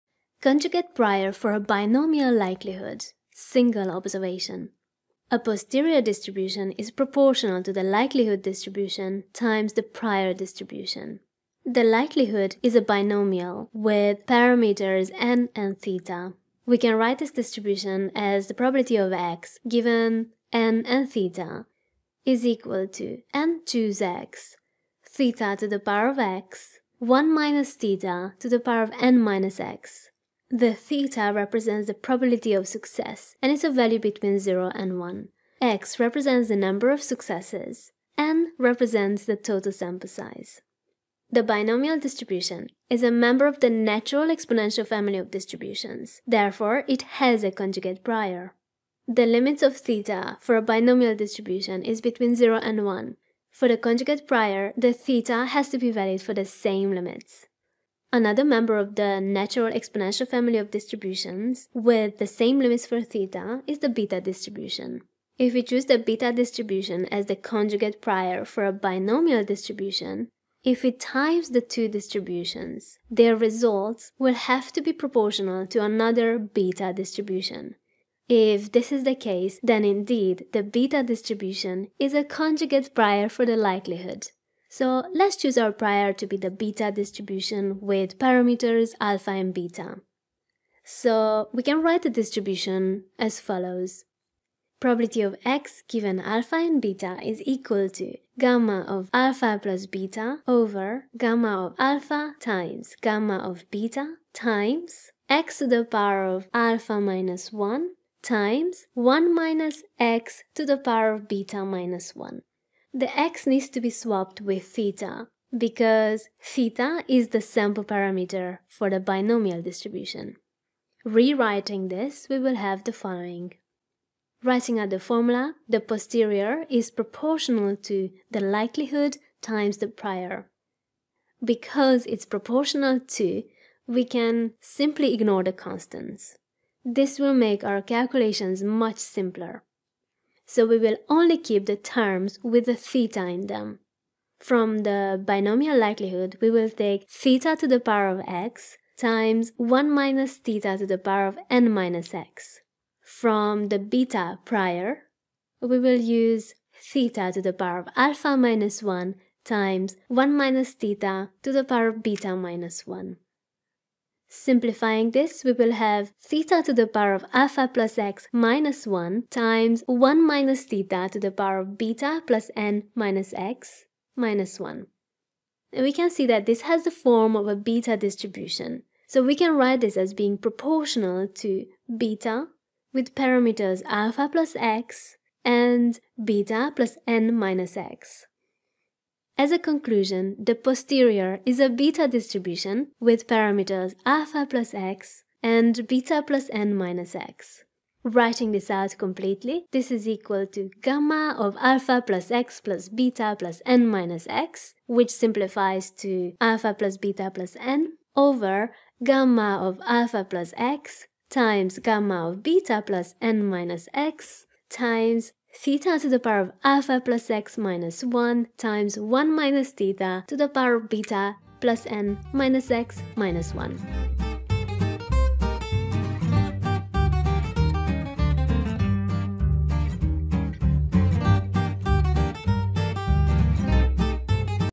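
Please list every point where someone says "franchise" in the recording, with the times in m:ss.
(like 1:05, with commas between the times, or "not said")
not said.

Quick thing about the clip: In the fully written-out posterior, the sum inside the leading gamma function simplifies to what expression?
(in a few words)
alpha plus beta plus n.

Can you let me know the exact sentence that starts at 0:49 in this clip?
The limits of theta for a binomial distribution is between 0 and 1.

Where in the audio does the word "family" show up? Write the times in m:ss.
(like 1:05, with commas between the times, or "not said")
0:44, 1:00.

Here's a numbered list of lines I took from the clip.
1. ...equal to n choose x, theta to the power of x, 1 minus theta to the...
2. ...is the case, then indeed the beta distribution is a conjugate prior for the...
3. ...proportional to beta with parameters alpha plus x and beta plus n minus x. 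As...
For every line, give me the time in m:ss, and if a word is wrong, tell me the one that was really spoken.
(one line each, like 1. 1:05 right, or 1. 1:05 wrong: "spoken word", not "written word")
1. 0:22 right
2. 1:18 right
3. 3:00 right.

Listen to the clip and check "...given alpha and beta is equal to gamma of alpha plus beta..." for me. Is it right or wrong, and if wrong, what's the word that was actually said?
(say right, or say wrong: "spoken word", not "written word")
right.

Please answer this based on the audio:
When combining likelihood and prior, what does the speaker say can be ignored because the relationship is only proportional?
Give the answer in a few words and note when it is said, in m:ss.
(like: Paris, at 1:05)
The constants, at 2:15.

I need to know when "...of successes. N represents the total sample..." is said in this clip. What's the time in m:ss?
0:36.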